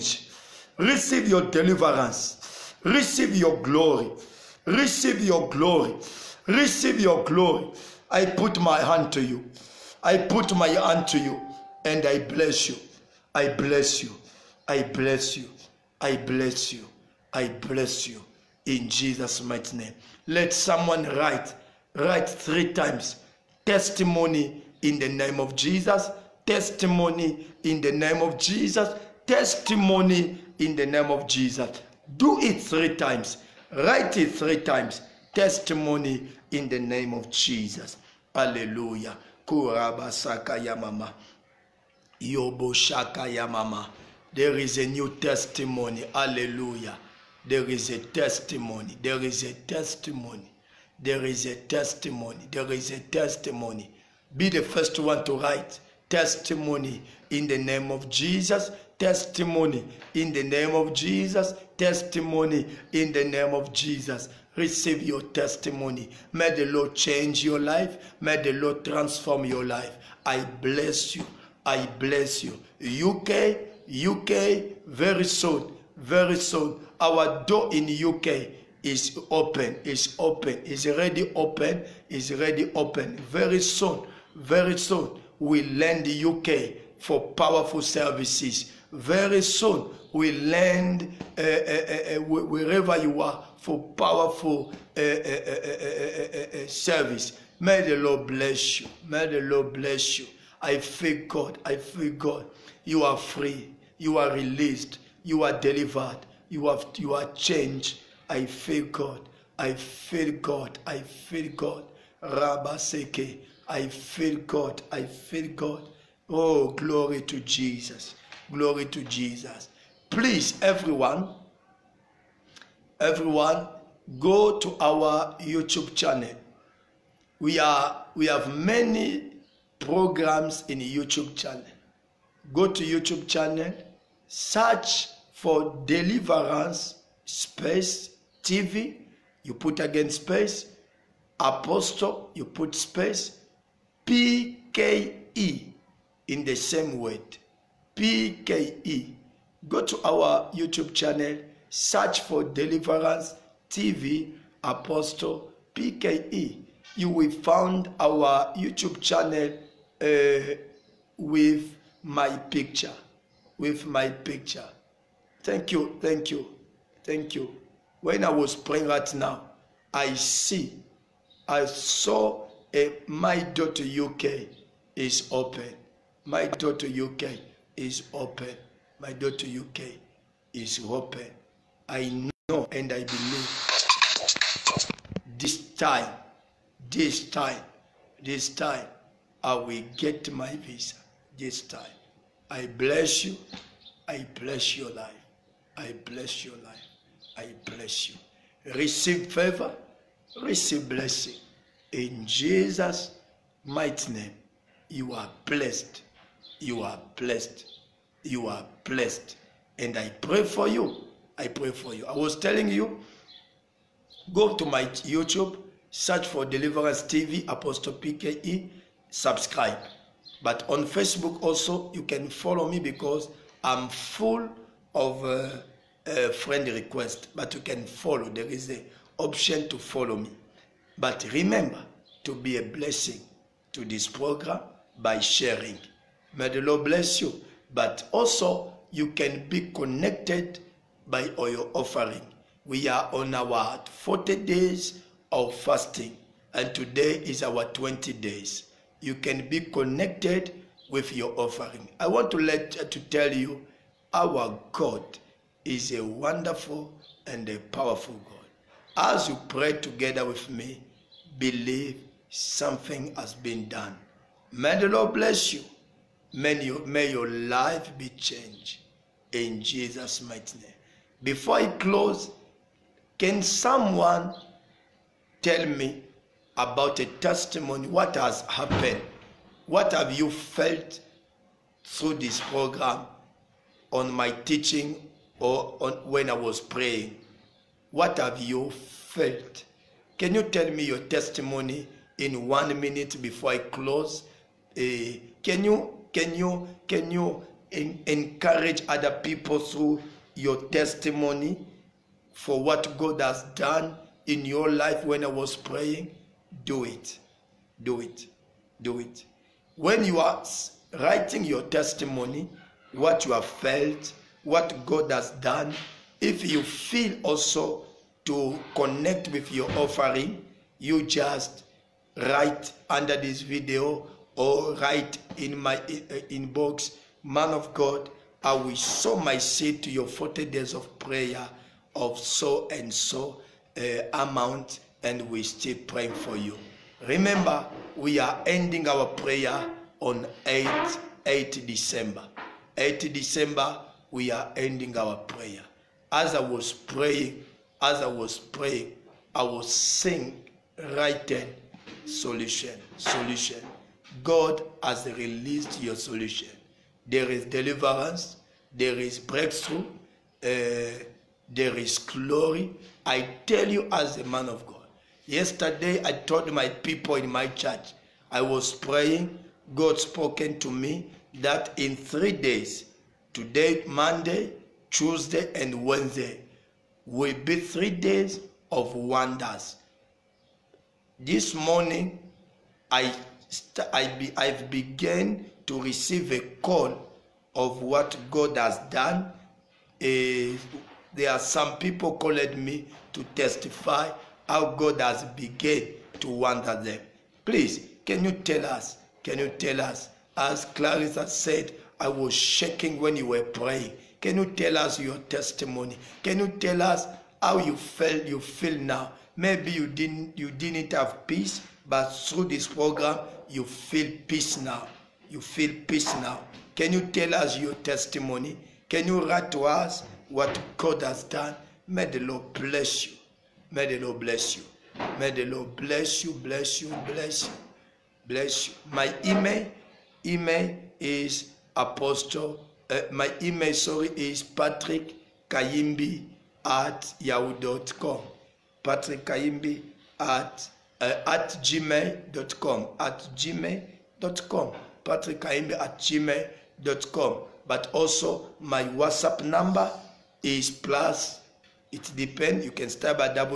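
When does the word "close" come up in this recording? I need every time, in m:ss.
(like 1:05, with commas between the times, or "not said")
4:31, 4:53.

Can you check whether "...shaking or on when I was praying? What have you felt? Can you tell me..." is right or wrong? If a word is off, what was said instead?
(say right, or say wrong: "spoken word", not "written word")
wrong: "teaching", not "shaking".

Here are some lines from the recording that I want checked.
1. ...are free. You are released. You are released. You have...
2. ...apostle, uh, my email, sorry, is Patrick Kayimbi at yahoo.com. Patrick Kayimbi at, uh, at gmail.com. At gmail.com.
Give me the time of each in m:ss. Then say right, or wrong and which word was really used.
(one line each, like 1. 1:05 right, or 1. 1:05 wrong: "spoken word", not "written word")
1. 1:43 wrong: "delivered", not "released"
2. 7:11 right.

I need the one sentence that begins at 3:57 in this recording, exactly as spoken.
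But also, you can be connected by your offering.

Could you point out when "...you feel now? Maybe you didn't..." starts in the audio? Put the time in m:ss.
6:48.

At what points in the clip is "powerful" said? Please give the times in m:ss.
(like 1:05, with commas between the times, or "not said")
1:27, 1:33, 4:17.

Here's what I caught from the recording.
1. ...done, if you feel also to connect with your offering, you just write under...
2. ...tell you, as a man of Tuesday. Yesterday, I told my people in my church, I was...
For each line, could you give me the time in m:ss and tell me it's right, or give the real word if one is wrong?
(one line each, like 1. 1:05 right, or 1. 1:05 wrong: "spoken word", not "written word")
1. 5:15 right
2. 6:03 wrong: "God", not "Tuesday".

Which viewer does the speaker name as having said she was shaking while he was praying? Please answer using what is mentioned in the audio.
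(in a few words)
Clarissa.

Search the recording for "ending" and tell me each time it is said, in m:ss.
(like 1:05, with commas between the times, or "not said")
5:38, 5:44.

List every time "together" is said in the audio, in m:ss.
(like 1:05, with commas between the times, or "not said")
4:19.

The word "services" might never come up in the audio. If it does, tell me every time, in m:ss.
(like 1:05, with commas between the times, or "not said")
1:27, 1:36.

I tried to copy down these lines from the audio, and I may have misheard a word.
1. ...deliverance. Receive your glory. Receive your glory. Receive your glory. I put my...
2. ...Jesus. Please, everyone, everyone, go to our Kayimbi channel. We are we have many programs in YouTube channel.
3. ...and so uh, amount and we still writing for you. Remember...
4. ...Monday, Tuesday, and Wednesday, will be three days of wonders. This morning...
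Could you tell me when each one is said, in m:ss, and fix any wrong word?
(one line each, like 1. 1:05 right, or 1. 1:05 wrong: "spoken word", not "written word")
1. 0:01 right
2. 1:59 wrong: "YouTube", not "Kayimbi"
3. 5:32 wrong: "praying", not "writing"
4. 6:13 right.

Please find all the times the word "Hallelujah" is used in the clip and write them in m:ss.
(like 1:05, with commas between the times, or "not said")
0:38, 0:46.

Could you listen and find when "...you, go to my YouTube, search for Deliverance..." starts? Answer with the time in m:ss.
3:32.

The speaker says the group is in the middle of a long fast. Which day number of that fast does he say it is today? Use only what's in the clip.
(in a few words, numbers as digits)
20.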